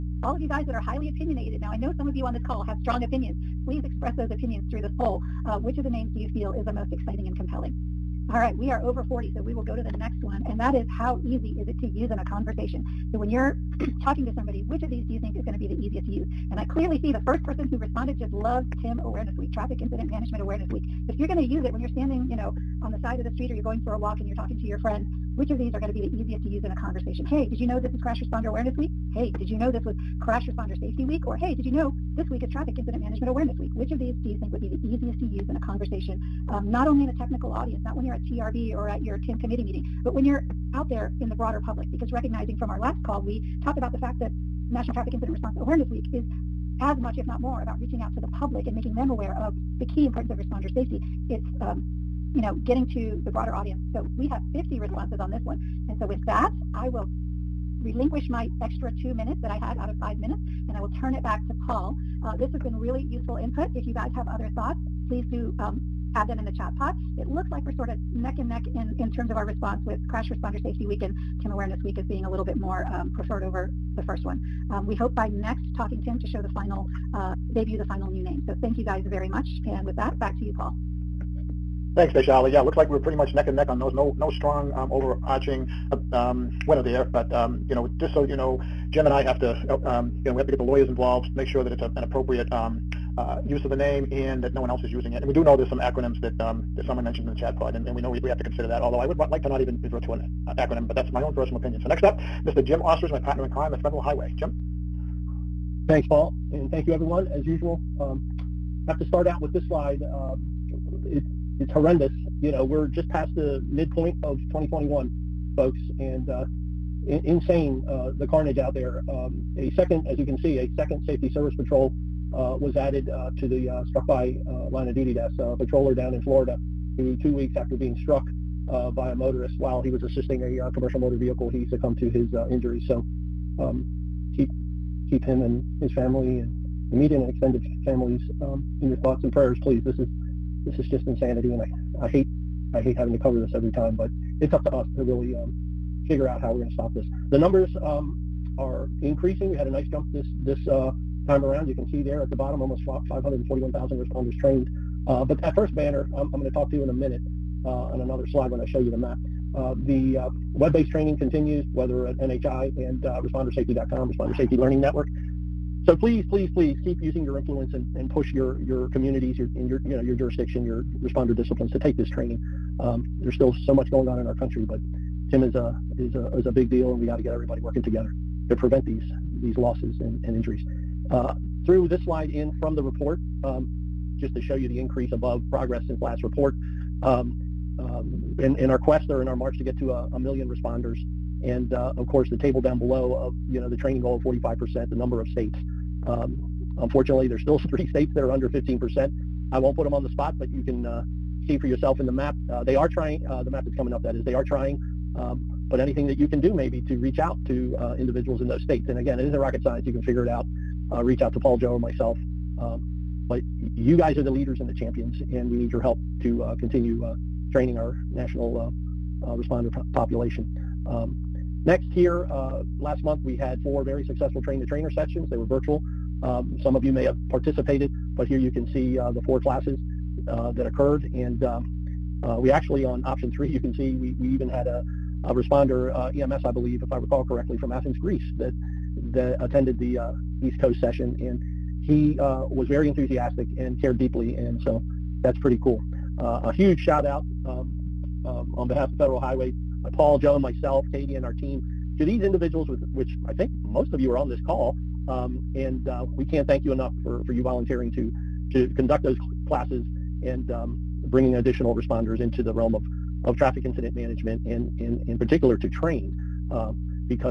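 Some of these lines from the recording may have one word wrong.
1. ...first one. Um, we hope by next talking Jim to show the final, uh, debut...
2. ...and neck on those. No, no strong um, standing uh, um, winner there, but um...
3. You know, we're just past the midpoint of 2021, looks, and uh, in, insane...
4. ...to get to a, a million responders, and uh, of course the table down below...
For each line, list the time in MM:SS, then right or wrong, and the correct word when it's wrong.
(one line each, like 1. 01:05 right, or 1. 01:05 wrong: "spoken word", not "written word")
1. 01:14 wrong: "TIM", not "Jim"
2. 01:23 wrong: "overarching", not "standing"
3. 01:52 wrong: "folks", not "looks"
4. 03:09 right.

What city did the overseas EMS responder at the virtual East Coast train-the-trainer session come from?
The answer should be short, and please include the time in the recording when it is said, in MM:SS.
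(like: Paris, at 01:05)
Athens, Greece, at 03:57.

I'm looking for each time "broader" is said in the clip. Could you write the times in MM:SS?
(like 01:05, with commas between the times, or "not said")
00:41, 00:53.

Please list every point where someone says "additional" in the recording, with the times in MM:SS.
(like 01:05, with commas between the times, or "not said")
04:21.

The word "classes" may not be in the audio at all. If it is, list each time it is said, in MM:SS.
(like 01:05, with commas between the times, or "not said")
03:49, 04:19.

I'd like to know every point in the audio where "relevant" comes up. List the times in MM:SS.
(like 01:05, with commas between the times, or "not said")
not said.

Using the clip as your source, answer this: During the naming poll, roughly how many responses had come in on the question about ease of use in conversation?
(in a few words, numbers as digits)
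50.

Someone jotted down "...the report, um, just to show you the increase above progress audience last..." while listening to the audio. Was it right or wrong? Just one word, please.
wrong.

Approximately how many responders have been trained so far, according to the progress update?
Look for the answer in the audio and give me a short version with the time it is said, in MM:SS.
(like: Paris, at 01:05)
541,000, at 02:32.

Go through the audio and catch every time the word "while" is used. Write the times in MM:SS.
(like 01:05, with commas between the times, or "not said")
02:09.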